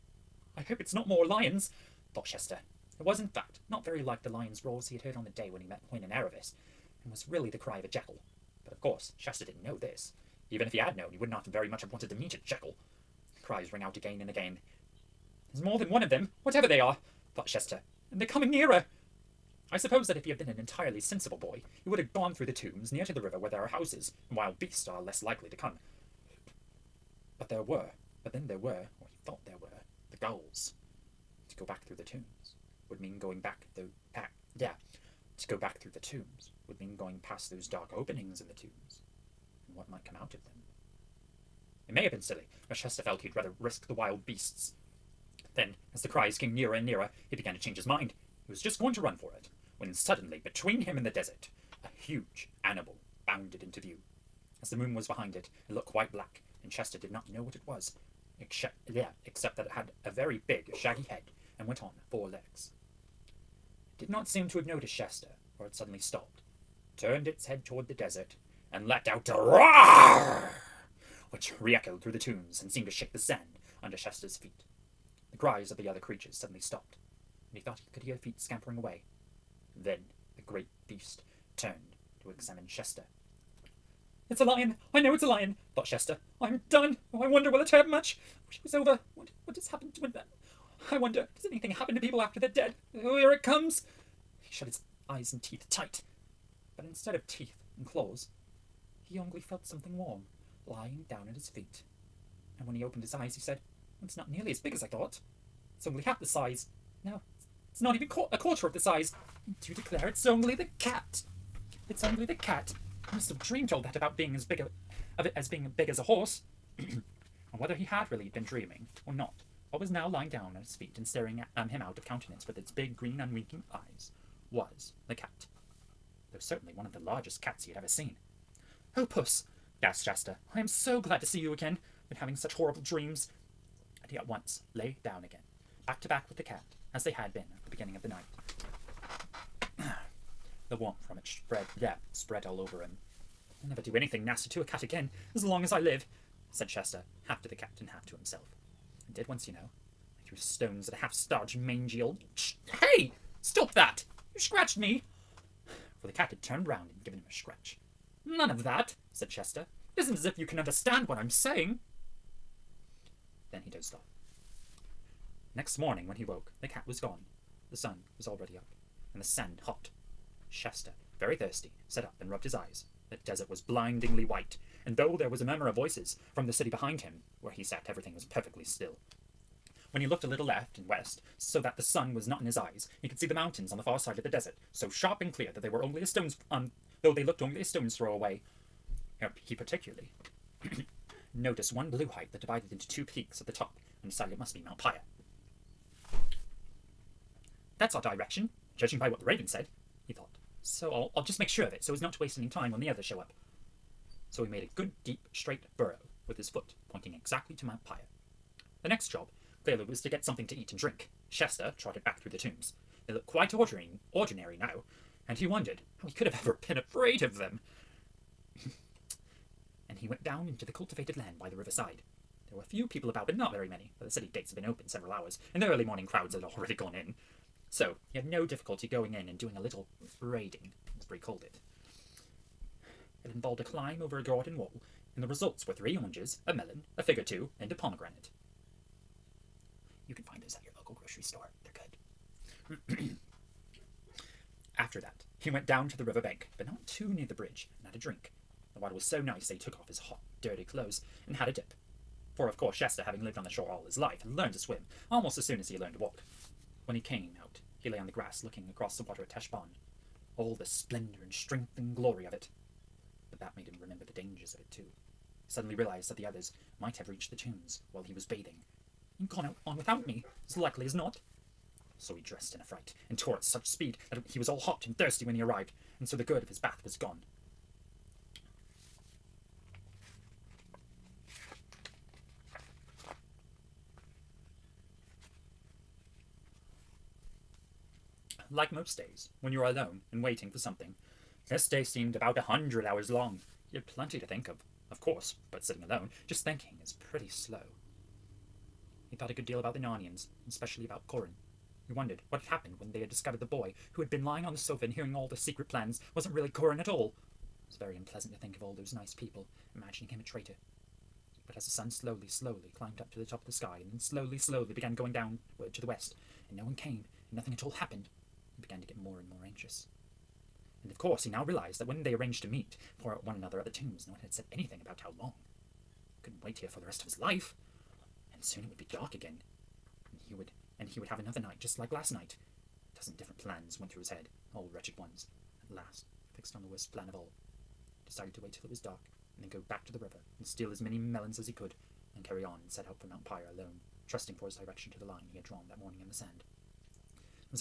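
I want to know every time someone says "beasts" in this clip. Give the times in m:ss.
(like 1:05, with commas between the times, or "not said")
0:24, 0:44, 1:20.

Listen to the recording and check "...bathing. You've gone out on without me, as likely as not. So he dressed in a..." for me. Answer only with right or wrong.
right.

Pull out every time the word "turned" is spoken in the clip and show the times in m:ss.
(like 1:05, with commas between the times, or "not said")
1:06, 1:21, 2:36.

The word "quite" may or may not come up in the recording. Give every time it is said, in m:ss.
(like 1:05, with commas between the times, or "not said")
0:55, 3:33.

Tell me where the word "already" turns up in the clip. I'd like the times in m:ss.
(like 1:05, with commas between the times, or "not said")
2:48, 3:46.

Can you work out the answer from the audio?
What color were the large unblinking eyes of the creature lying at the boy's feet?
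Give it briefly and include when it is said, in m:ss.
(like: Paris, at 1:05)
Green, at 2:02.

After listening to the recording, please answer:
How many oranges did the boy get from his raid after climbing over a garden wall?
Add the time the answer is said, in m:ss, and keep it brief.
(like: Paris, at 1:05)
3, at 3:55.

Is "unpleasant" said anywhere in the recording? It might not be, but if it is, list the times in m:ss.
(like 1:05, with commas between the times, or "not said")
5:07.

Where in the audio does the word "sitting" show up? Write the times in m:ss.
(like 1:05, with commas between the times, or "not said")
4:55.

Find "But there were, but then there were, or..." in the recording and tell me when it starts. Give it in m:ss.
0:27.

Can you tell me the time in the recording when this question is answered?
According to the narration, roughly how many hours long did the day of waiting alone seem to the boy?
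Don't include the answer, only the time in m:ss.
4:52.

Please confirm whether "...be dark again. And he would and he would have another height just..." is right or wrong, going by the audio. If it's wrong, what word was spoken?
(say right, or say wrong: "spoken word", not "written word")
wrong: "night", not "height".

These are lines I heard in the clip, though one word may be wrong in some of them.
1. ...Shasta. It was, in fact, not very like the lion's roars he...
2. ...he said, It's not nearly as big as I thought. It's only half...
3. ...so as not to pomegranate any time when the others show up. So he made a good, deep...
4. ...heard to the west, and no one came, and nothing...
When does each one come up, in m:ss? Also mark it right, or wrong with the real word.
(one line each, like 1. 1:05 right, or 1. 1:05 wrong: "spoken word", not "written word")
1. 0:02 right
2. 1:43 right
3. 3:21 wrong: "waste", not "pomegranate"
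4. 5:15 wrong: "downward", not "heard".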